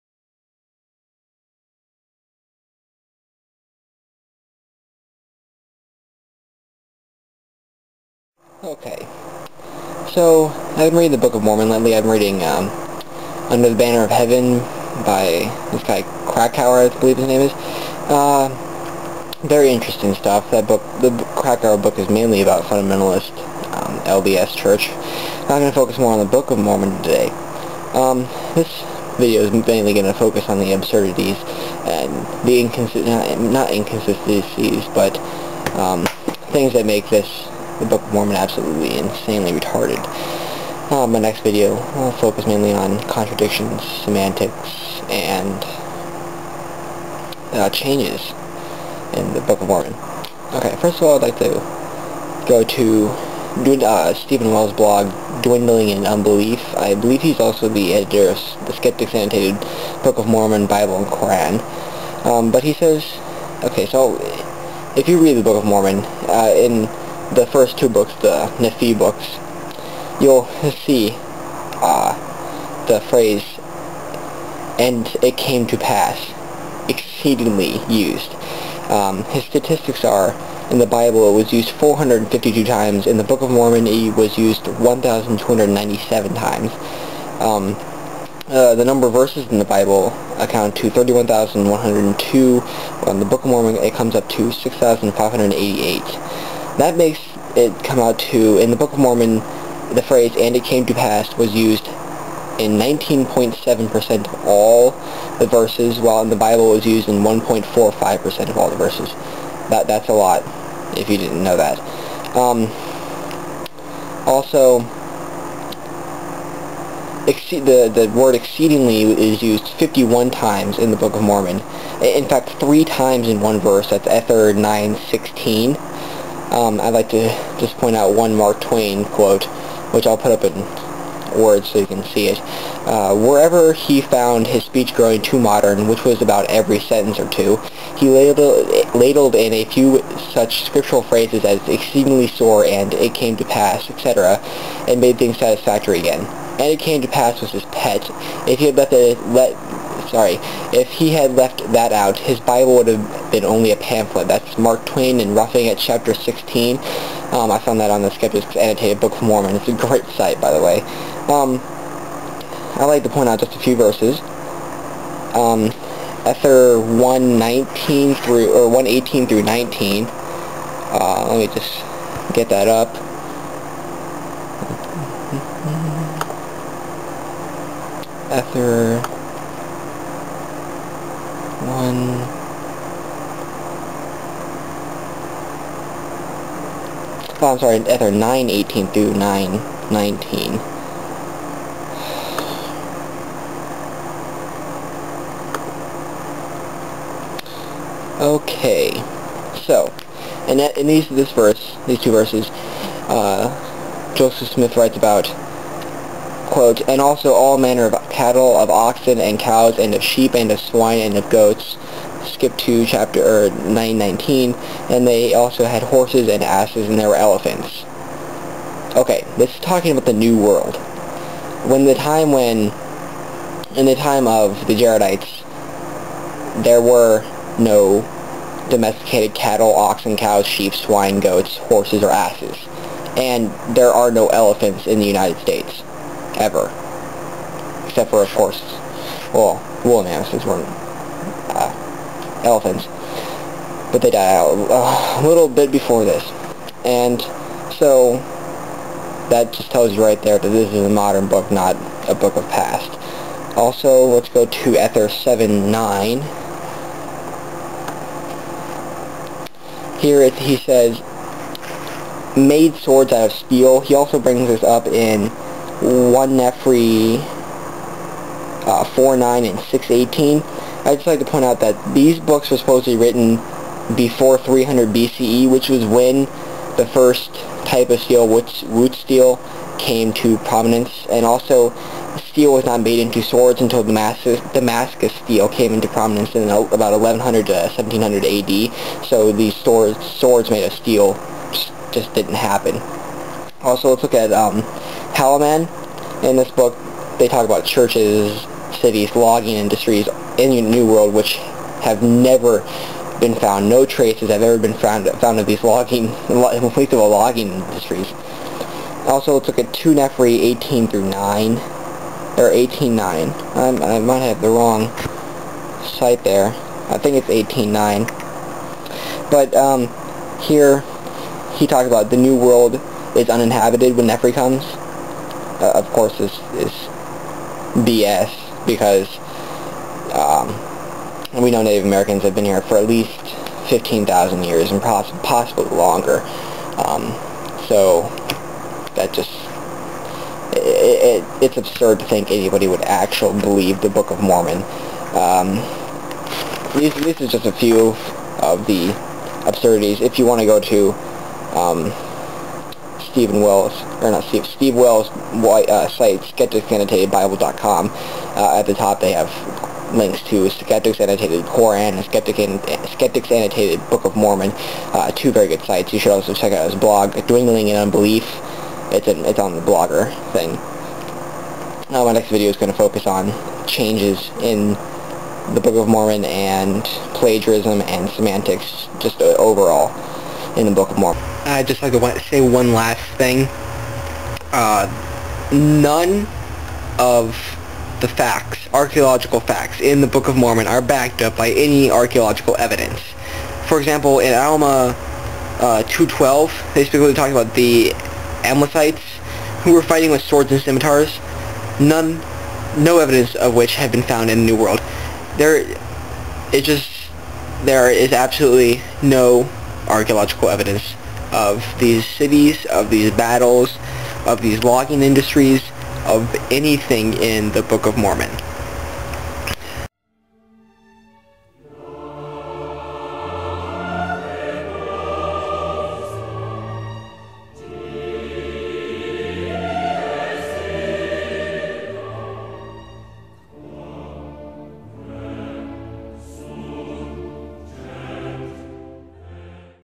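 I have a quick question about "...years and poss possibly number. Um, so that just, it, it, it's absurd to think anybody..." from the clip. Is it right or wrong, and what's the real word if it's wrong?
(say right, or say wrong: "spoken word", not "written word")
wrong: "longer", not "number".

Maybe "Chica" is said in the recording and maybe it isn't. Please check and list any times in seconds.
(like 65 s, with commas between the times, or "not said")
not said.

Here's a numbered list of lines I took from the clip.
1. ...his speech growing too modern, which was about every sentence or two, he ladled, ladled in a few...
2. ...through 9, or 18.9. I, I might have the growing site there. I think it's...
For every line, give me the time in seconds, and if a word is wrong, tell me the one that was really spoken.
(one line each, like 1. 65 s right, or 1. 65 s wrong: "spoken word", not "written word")
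1. 134 s right
2. 310 s wrong: "wrong", not "growing".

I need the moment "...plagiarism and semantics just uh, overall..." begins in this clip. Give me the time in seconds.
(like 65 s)
377 s.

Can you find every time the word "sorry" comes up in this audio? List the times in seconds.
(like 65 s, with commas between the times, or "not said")
150 s, 187 s.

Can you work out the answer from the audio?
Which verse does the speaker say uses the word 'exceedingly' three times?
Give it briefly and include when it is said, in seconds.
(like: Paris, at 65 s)
Ether 9:16, at 124 s.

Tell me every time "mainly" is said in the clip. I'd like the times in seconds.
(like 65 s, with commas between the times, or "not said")
22 s, 29 s, 42 s.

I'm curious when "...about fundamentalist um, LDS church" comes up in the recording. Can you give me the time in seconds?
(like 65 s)
22 s.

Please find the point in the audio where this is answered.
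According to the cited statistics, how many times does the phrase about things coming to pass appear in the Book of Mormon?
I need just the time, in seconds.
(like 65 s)
84 s.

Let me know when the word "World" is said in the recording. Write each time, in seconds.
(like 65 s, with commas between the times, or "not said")
220 s, 300 s, 322 s, 404 s.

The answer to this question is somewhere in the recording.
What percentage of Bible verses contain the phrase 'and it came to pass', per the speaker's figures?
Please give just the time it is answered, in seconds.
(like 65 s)
107 s.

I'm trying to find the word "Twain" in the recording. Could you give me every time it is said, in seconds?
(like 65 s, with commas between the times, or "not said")
128 s, 154 s.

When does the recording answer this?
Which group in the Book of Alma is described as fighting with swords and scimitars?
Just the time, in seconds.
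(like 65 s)
398 s.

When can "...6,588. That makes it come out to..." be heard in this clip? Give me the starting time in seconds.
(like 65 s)
94 s.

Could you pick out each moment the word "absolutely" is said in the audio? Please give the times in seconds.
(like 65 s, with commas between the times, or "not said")
38 s, 408 s.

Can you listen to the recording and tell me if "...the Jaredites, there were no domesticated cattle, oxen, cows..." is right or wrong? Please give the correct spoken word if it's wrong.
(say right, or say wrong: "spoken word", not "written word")
right.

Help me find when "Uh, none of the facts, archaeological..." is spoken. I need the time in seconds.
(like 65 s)
384 s.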